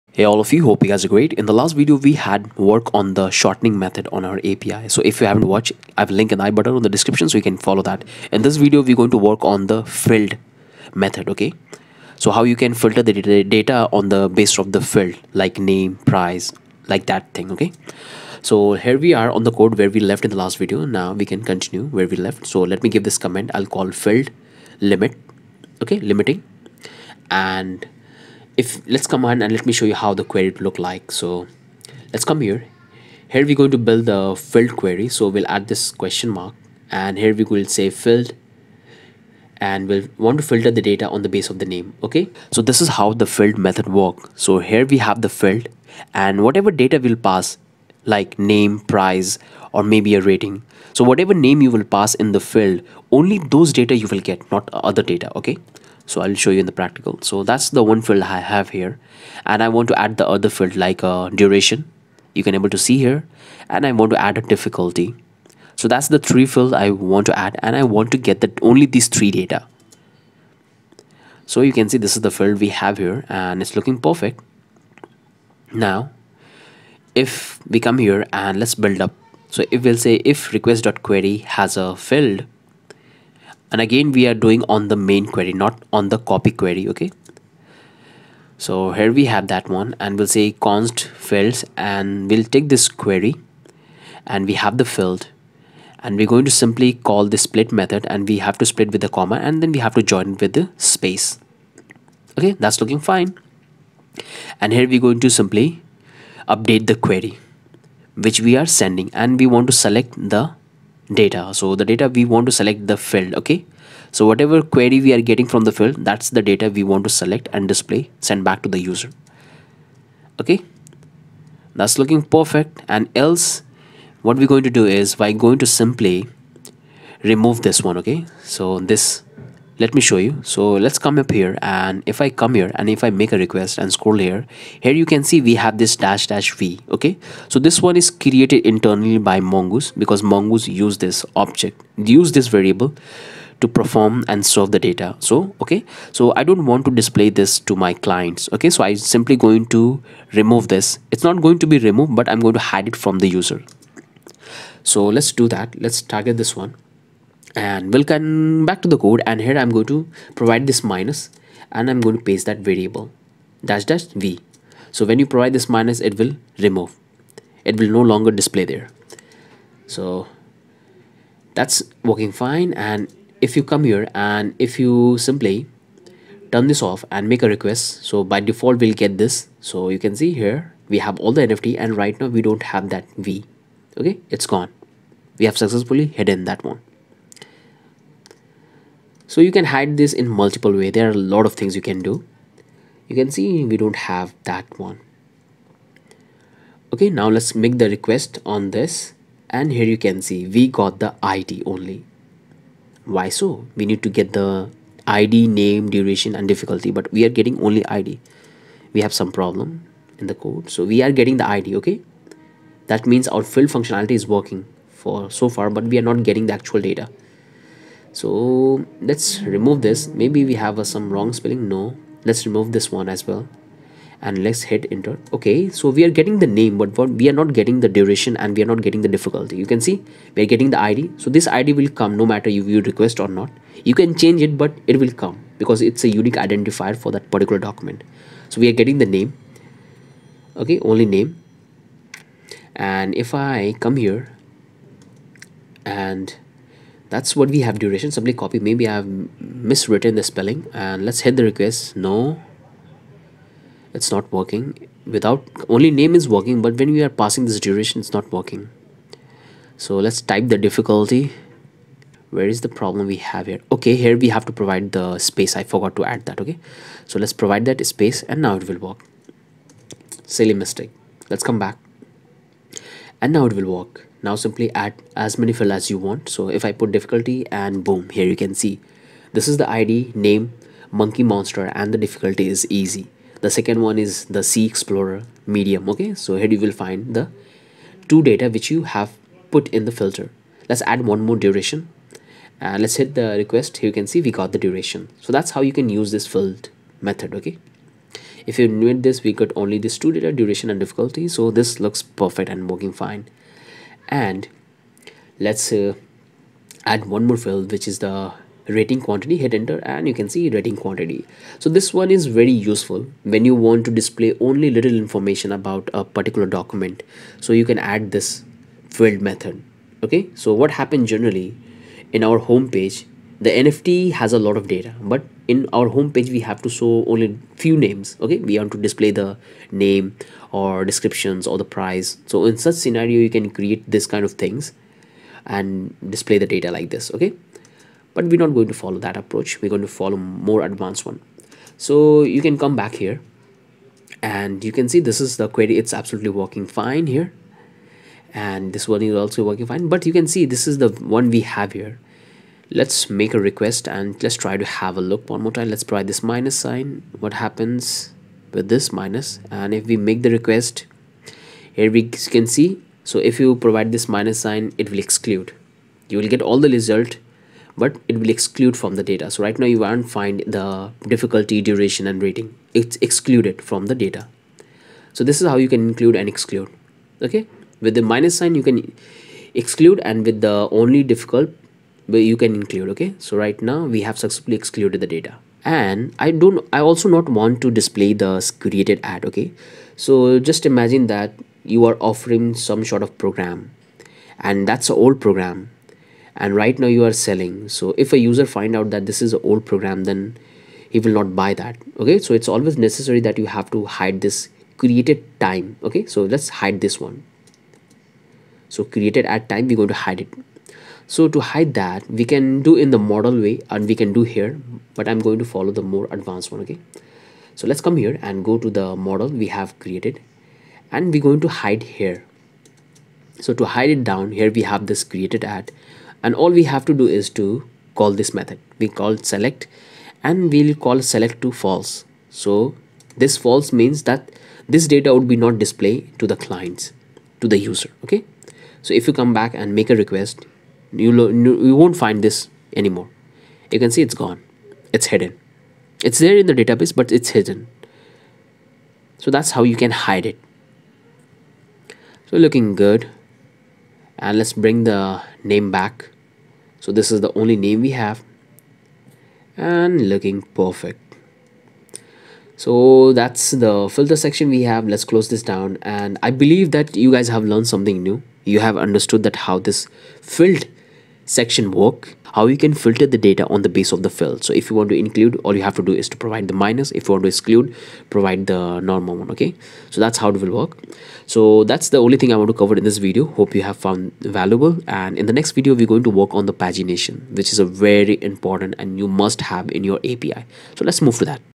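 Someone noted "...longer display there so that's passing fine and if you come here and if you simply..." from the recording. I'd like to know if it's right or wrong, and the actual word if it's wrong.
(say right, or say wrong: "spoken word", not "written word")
wrong: "working", not "passing".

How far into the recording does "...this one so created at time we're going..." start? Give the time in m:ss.
6:46.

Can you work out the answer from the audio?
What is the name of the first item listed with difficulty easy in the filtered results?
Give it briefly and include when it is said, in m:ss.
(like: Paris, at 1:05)
Monkey Monster, at 4:40.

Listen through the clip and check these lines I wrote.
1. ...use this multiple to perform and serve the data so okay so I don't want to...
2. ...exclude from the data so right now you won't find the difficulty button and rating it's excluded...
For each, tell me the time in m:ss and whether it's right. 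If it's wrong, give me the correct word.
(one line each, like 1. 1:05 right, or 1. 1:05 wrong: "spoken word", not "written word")
1. 2:22 wrong: "variable", not "multiple"
2. 6:08 wrong: "duration", not "button".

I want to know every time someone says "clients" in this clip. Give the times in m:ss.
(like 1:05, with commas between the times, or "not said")
2:28, 7:16.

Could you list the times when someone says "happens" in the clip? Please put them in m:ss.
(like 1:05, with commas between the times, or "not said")
5:20, 5:57.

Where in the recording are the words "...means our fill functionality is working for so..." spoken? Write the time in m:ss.
3:33.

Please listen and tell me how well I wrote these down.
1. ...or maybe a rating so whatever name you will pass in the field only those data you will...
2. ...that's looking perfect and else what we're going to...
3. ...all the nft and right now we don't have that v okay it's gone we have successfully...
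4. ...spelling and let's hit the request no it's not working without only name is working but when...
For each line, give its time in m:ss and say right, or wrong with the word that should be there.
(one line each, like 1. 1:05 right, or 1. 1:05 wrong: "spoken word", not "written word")
1. 0:49 right
2. 2:01 right
3. 3:01 right
4. 4:10 right.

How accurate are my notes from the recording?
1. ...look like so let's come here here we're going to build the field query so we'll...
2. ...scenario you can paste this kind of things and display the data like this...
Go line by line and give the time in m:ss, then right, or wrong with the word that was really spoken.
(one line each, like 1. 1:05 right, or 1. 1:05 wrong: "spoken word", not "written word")
1. 0:30 right
2. 5:32 wrong: "create", not "paste".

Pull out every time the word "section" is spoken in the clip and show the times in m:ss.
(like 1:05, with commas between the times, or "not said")
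7:44, 7:51.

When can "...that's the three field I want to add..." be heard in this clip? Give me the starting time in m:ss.
1:05.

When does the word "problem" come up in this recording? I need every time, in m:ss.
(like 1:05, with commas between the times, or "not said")
3:29, 4:22.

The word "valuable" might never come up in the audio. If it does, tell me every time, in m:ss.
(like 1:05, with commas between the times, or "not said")
8:04.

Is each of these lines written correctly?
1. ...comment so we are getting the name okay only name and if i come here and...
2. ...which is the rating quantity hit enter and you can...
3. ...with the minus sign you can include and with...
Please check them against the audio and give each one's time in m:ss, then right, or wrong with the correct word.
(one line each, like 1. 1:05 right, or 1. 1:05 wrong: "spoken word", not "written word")
1. 3:57 wrong: "document", not "comment"
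2. 5:07 right
3. 6:17 wrong: "exclude", not "include".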